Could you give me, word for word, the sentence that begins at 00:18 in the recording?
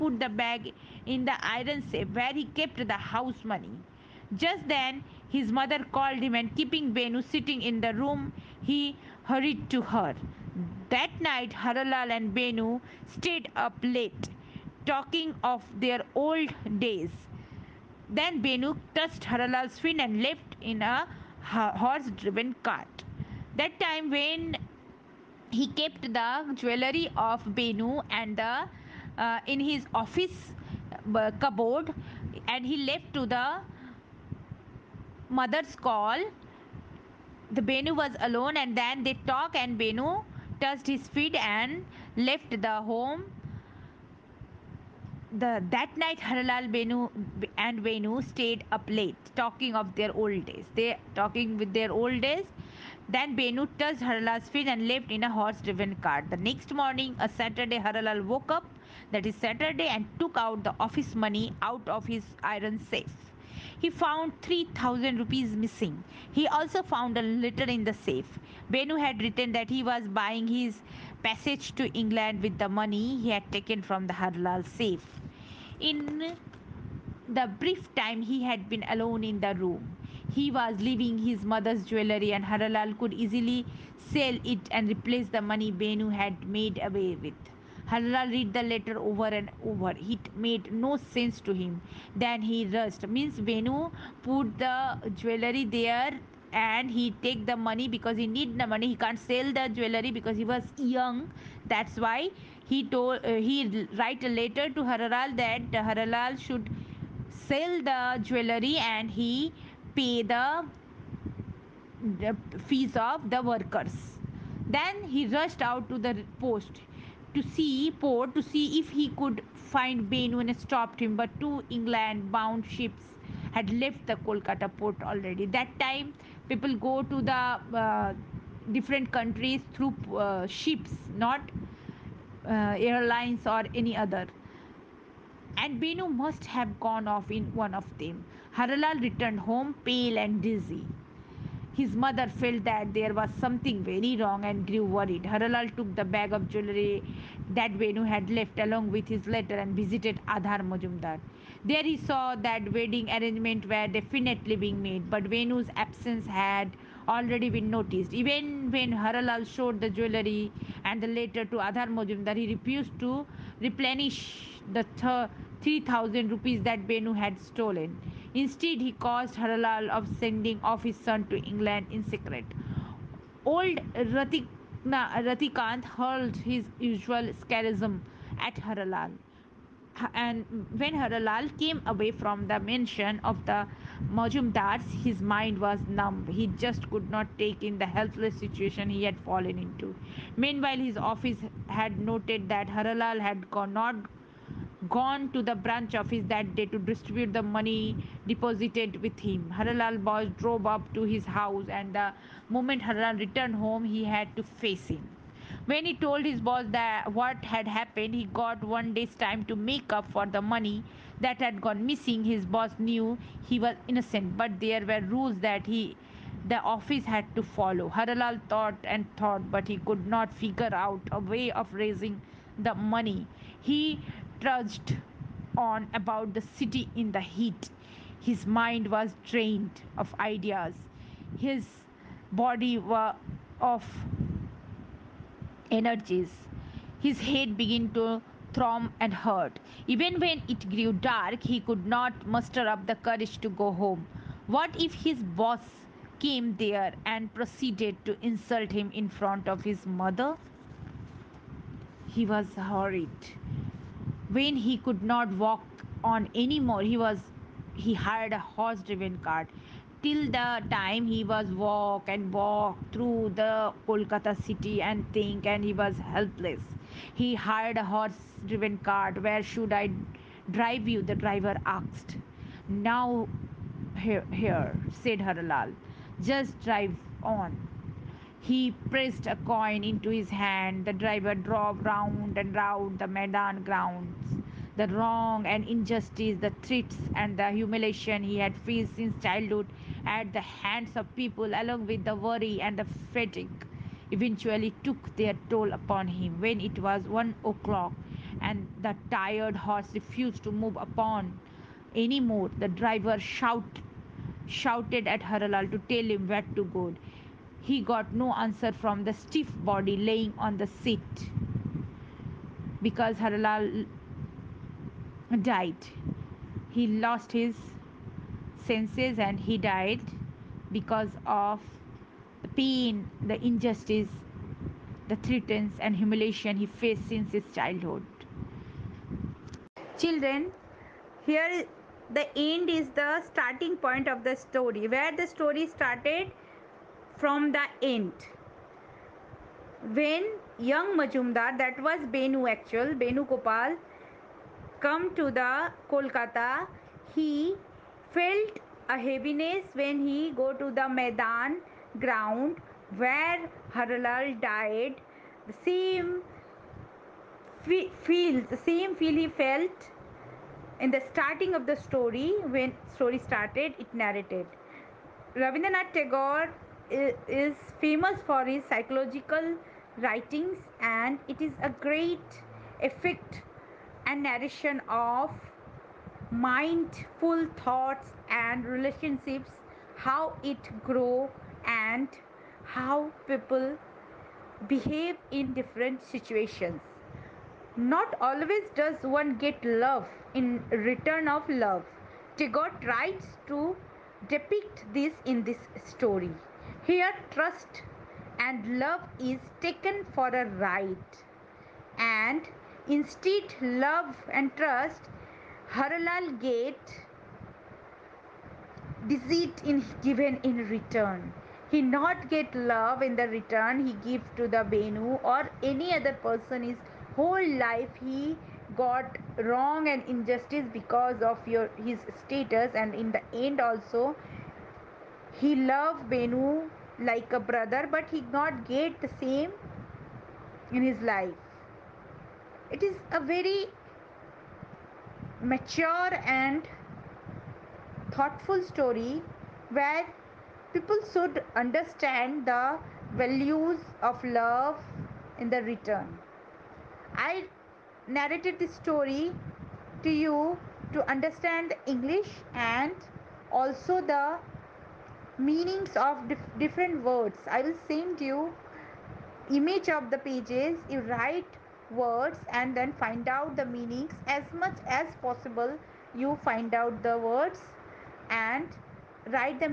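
Then Venu touched Haralal's fin and left in a horse driven cart.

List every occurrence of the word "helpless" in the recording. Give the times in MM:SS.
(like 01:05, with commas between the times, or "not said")
03:07, 04:26.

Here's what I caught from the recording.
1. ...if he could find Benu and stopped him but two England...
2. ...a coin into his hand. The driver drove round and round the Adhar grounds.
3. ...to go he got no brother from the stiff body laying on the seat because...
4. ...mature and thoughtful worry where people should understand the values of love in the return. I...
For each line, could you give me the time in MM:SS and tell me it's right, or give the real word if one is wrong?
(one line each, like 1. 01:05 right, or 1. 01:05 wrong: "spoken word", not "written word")
1. 01:58 right
2. 04:39 wrong: "Maidan", not "Adhar"
3. 05:06 wrong: "answer", not "brother"
4. 07:15 wrong: "story", not "worry".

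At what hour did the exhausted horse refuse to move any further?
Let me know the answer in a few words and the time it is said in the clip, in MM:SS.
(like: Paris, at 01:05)
one o'clock, at 04:57.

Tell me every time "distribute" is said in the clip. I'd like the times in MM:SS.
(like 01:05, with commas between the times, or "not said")
03:16.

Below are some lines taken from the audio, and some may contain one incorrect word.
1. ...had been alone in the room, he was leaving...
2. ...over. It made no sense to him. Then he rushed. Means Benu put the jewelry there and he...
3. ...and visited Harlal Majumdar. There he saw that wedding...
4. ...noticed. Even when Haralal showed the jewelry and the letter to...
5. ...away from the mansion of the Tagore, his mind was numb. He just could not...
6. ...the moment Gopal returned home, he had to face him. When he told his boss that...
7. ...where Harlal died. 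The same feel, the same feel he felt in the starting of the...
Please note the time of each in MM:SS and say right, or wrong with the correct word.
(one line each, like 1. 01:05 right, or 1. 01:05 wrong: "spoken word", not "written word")
1. 01:18 right
2. 01:29 right
3. 02:29 wrong: "Adhar", not "Harlal"
4. 02:37 right
5. 03:01 wrong: "Majumdars", not "Tagore"
6. 03:21 wrong: "Haralal", not "Gopal"
7. 05:52 right.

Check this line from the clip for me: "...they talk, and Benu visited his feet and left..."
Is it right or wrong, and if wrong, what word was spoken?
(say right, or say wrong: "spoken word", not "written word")
wrong: "touched", not "visited".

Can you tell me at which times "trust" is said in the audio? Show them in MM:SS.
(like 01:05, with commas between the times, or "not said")
06:37, 06:44.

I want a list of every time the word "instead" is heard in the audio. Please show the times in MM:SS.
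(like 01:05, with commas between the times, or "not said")
02:48, 06:42.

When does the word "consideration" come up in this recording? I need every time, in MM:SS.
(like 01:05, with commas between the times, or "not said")
not said.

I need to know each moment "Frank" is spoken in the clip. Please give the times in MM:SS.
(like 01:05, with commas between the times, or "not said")
not said.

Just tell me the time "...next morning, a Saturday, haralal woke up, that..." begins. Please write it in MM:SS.
00:56.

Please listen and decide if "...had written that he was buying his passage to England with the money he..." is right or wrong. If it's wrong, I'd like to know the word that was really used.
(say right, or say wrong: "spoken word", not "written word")
right.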